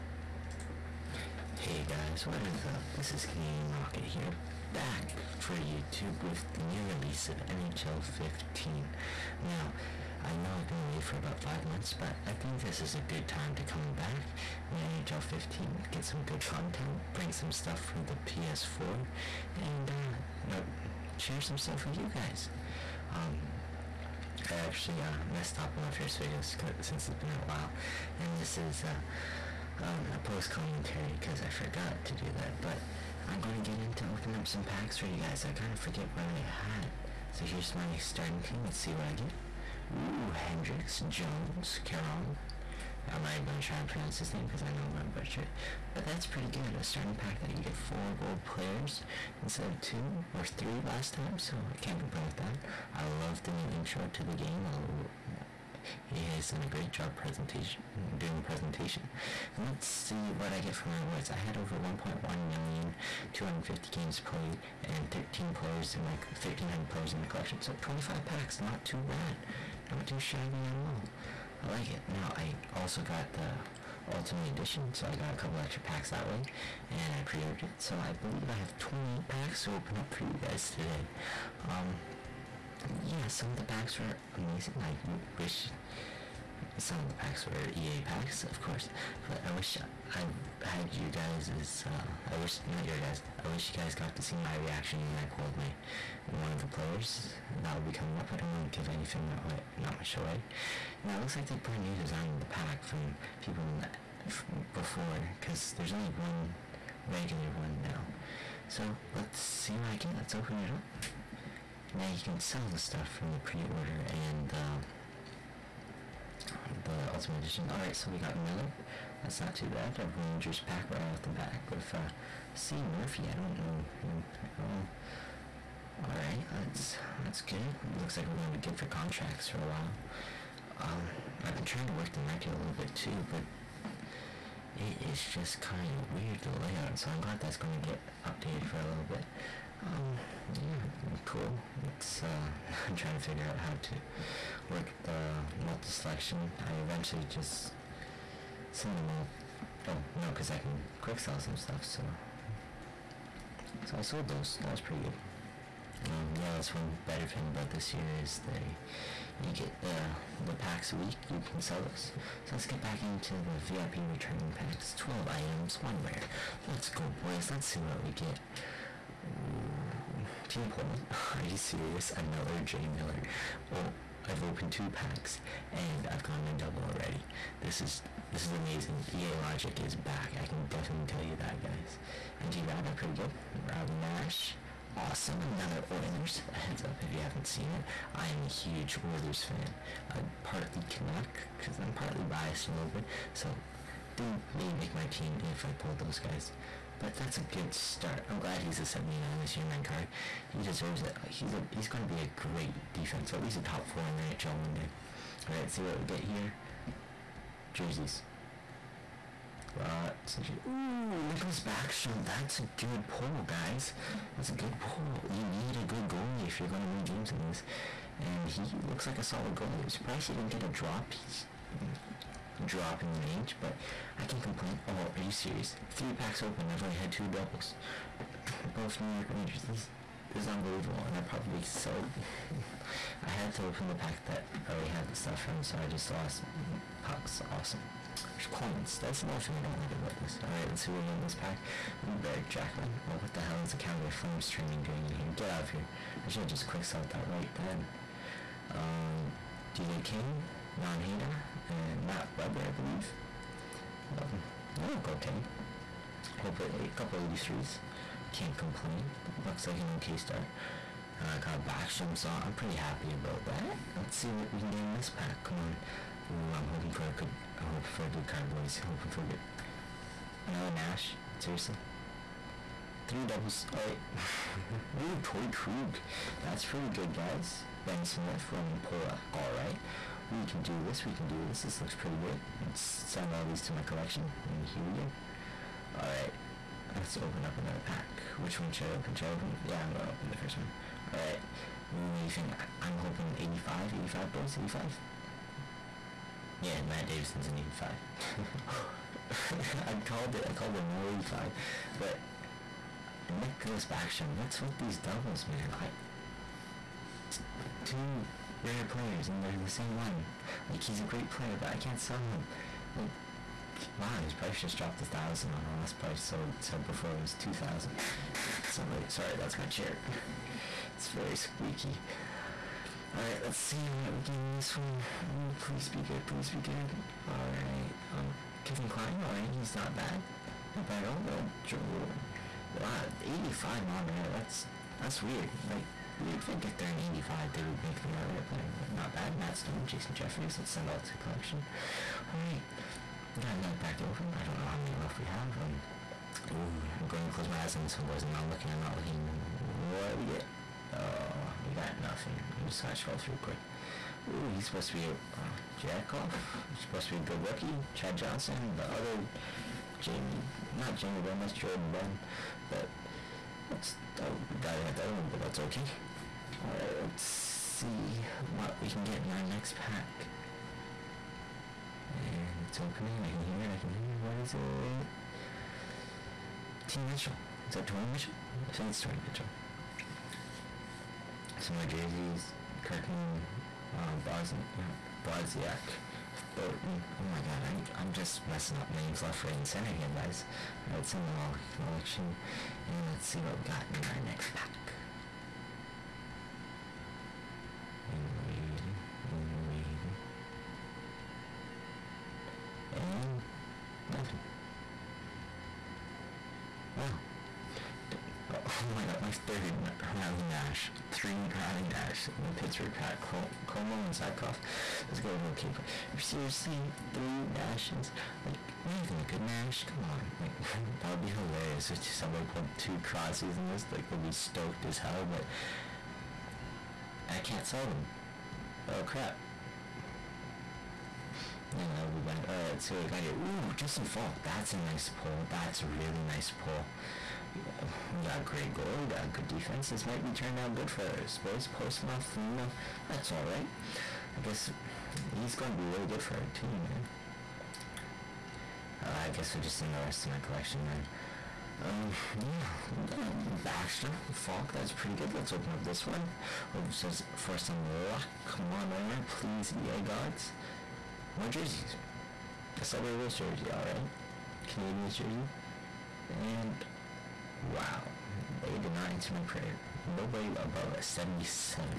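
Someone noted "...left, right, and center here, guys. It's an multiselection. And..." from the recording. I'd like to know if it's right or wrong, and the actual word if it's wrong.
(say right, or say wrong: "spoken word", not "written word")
wrong: "election", not "multiselection".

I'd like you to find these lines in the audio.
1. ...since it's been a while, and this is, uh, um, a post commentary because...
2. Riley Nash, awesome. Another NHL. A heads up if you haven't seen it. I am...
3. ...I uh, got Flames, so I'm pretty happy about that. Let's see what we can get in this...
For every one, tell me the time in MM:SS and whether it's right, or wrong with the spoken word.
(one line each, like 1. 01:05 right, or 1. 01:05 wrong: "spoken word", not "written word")
1. 00:26 right
2. 03:03 wrong: "Oilers", not "NHL"
3. 04:21 wrong: "Backstrom", not "Flames".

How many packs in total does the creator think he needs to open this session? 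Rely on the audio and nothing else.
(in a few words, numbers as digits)
20.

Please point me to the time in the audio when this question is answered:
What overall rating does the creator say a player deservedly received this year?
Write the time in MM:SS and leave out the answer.
03:18.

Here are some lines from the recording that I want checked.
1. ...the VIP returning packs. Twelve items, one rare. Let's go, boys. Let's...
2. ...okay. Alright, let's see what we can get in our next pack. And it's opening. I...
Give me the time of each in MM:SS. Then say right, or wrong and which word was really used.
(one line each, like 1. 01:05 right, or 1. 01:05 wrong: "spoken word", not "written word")
1. 02:43 right
2. 06:05 right.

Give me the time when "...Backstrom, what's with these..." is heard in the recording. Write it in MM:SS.
05:03.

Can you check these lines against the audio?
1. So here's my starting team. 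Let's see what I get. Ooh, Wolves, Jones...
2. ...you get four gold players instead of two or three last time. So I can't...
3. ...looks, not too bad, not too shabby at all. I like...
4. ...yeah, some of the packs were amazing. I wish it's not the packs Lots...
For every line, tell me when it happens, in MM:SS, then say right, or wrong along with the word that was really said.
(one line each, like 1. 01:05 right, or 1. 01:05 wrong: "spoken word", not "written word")
1. 00:37 wrong: "Hendrix", not "Wolves"
2. 00:47 right
3. 01:08 wrong: "packs", not "looks"
4. 01:23 wrong: "Were", not "Lots".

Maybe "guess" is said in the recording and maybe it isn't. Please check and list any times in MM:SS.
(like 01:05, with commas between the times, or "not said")
07:24, 07:29.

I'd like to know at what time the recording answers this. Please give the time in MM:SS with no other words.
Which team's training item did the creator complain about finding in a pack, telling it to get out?
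04:03.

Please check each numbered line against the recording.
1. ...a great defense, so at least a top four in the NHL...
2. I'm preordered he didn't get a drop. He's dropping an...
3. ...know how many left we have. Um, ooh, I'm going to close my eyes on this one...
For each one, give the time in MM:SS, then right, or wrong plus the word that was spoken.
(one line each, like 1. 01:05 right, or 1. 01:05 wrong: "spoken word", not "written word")
1. 03:22 right
2. 03:39 wrong: "surprised", not "preordered"
3. 05:44 right.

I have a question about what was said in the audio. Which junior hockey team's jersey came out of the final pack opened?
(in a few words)
Sudbury Wolves.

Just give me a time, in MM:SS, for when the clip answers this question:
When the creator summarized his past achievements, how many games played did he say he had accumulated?
01:03.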